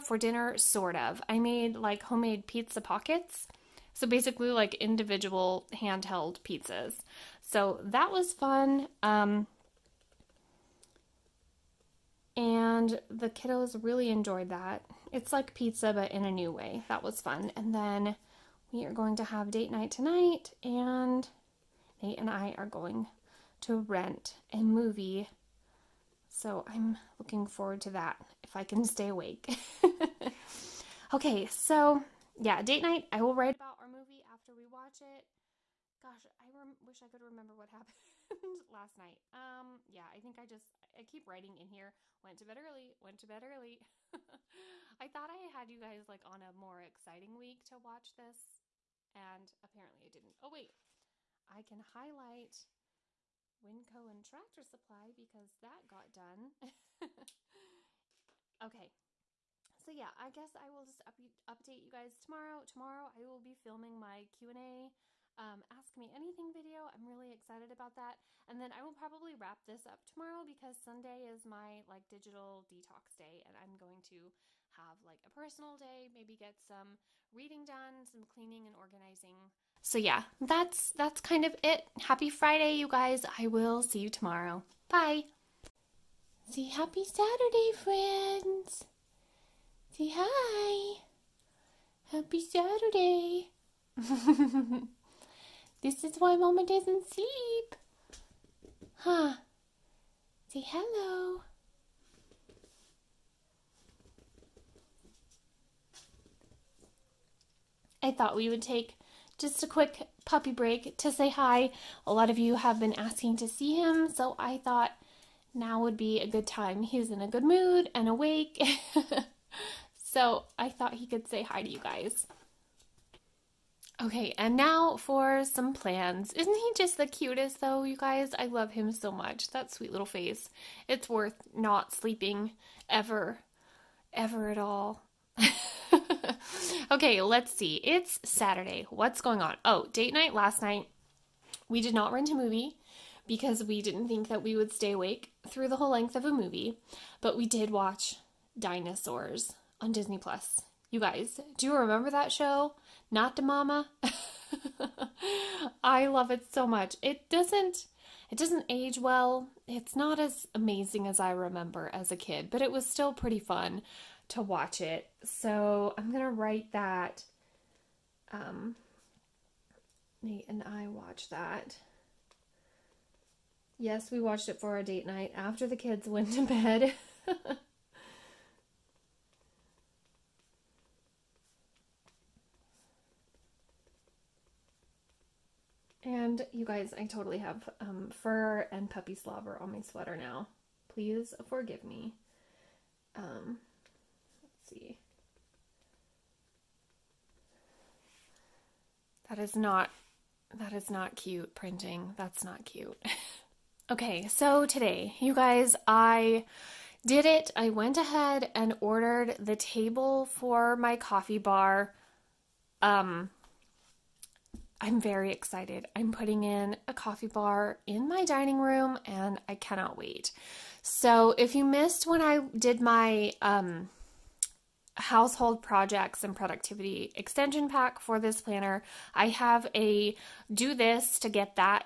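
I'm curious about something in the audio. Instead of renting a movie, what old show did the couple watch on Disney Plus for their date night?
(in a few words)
Dinosaurs.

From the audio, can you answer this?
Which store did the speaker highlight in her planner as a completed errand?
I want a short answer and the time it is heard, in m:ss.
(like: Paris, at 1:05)
WinCo, at 0:53.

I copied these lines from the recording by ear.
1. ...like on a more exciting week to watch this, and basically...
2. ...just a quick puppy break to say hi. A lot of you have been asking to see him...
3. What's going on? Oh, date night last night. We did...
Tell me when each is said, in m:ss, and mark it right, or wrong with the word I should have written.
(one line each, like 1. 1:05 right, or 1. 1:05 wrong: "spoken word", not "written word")
1. 0:46 wrong: "apparently", not "basically"
2. 1:49 right
3. 2:18 right.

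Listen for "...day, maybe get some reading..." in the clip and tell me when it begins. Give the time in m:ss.
1:15.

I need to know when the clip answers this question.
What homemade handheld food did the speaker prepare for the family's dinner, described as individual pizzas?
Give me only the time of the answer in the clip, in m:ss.
0:02.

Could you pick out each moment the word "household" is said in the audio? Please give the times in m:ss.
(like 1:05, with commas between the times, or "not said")
3:44.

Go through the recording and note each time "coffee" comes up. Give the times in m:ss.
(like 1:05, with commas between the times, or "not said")
3:30, 3:36.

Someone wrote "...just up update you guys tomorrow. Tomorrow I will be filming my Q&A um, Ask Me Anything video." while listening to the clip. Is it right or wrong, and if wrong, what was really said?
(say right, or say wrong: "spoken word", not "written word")
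right.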